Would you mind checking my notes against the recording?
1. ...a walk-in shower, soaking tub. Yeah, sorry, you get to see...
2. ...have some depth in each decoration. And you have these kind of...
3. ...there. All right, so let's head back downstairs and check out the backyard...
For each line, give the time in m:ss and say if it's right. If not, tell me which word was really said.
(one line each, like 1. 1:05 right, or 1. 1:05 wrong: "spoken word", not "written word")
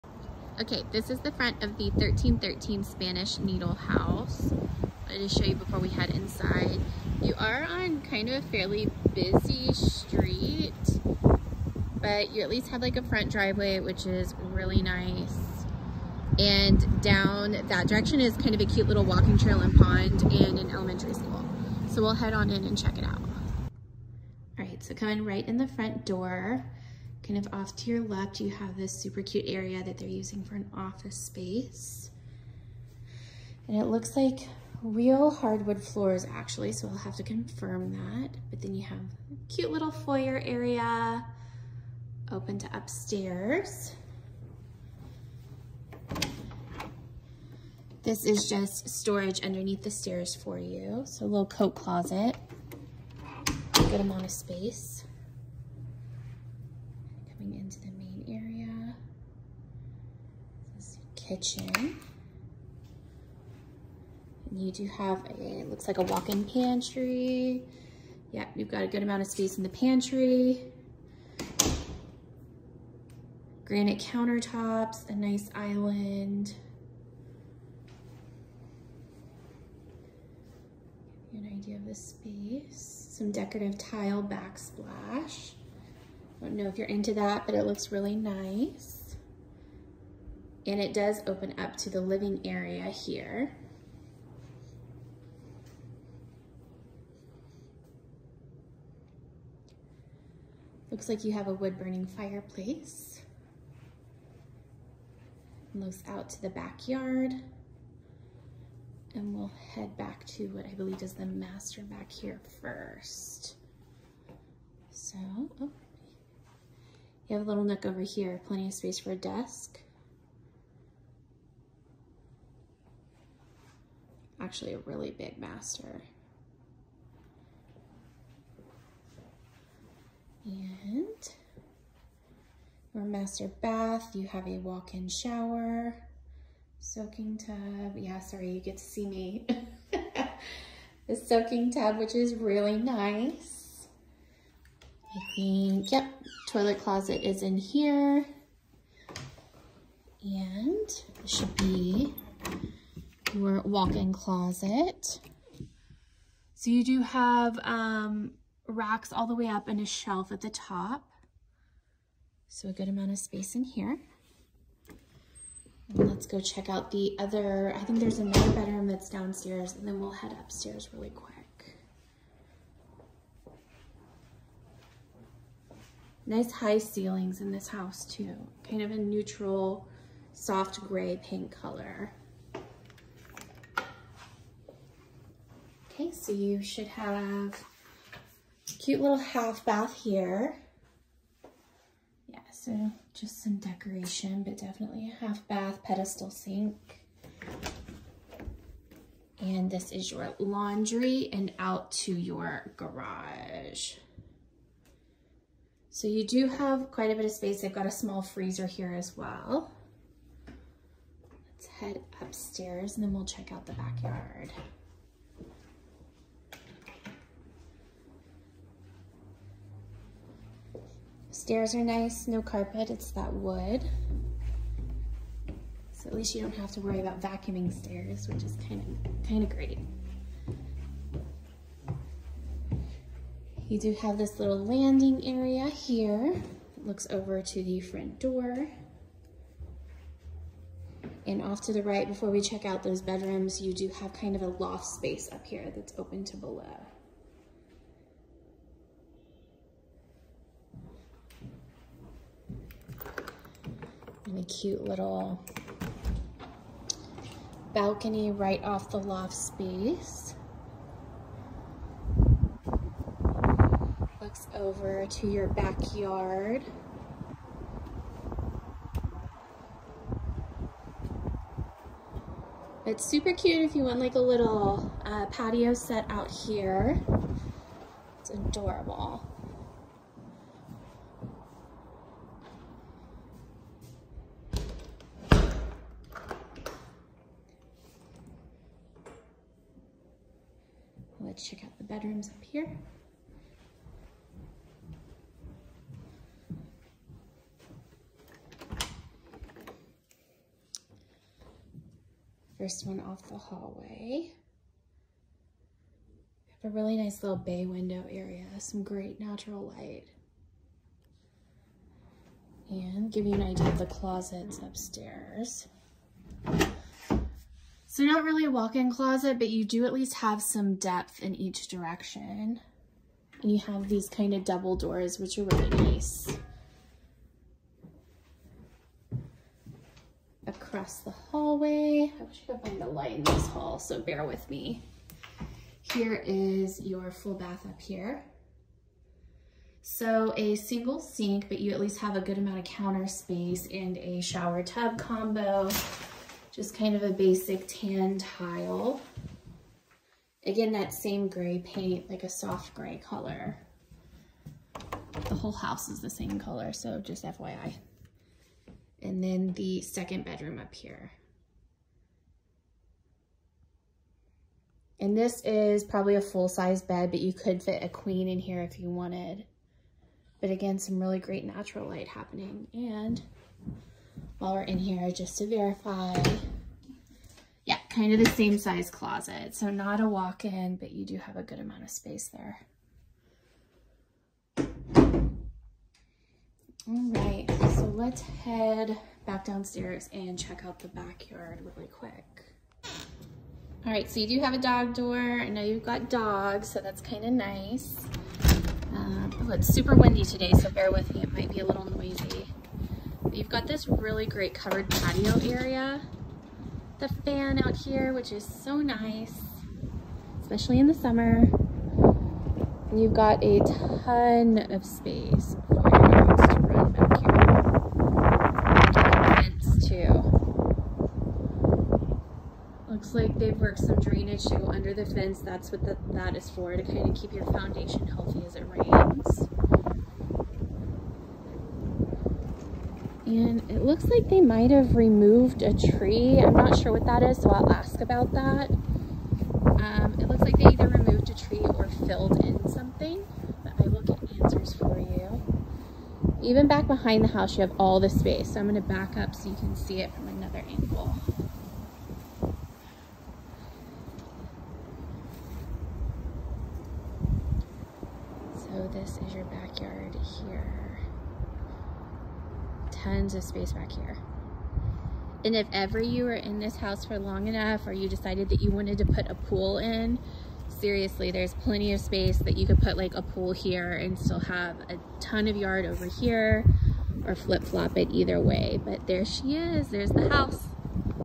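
1. 2:14 right
2. 5:20 wrong: "direction", not "decoration"
3. 6:22 right.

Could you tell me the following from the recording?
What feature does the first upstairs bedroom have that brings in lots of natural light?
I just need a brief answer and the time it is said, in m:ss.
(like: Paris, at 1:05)
bay window, at 5:07.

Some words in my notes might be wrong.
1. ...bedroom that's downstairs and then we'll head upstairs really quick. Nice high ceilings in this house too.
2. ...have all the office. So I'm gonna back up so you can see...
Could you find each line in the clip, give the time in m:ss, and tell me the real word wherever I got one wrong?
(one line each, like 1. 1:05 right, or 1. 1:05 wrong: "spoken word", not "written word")
1. 2:48 right
2. 7:27 wrong: "space", not "office".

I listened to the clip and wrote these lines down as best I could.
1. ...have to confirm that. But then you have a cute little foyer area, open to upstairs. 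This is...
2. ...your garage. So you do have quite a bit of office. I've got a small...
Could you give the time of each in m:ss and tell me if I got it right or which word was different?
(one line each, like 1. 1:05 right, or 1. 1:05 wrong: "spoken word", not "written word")
1. 0:36 right
2. 3:22 wrong: "space", not "office".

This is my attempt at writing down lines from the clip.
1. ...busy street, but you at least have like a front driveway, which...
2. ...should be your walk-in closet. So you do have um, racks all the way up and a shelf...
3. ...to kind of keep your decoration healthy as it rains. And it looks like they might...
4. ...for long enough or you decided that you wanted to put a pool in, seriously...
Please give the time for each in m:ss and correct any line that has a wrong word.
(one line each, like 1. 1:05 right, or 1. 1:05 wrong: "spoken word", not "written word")
1. 0:09 right
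2. 2:31 right
3. 7:06 wrong: "foundation", not "decoration"
4. 7:47 right.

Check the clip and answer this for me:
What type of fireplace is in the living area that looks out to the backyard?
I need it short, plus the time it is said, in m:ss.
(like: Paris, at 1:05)
wood burning, at 1:41.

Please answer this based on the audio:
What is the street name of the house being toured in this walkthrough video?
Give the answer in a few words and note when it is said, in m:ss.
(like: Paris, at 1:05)
Spanish Needle, at 0:02.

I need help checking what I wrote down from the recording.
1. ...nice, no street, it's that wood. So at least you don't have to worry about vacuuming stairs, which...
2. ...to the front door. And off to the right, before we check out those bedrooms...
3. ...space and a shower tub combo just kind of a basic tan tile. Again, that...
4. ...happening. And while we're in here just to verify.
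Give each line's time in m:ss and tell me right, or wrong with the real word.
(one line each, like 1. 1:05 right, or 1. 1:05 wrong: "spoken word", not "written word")
1. 3:41 wrong: "carpet", not "street"
2. 3:57 right
3. 5:43 right
4. 6:12 right.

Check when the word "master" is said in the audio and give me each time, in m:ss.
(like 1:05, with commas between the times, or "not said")
1:51, 2:05, 2:13.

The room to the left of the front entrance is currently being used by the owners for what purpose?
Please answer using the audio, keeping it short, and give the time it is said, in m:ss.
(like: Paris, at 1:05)
office space, at 0:30.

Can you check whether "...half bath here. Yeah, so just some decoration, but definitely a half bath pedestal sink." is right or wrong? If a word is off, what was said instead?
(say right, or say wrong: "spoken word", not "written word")
right.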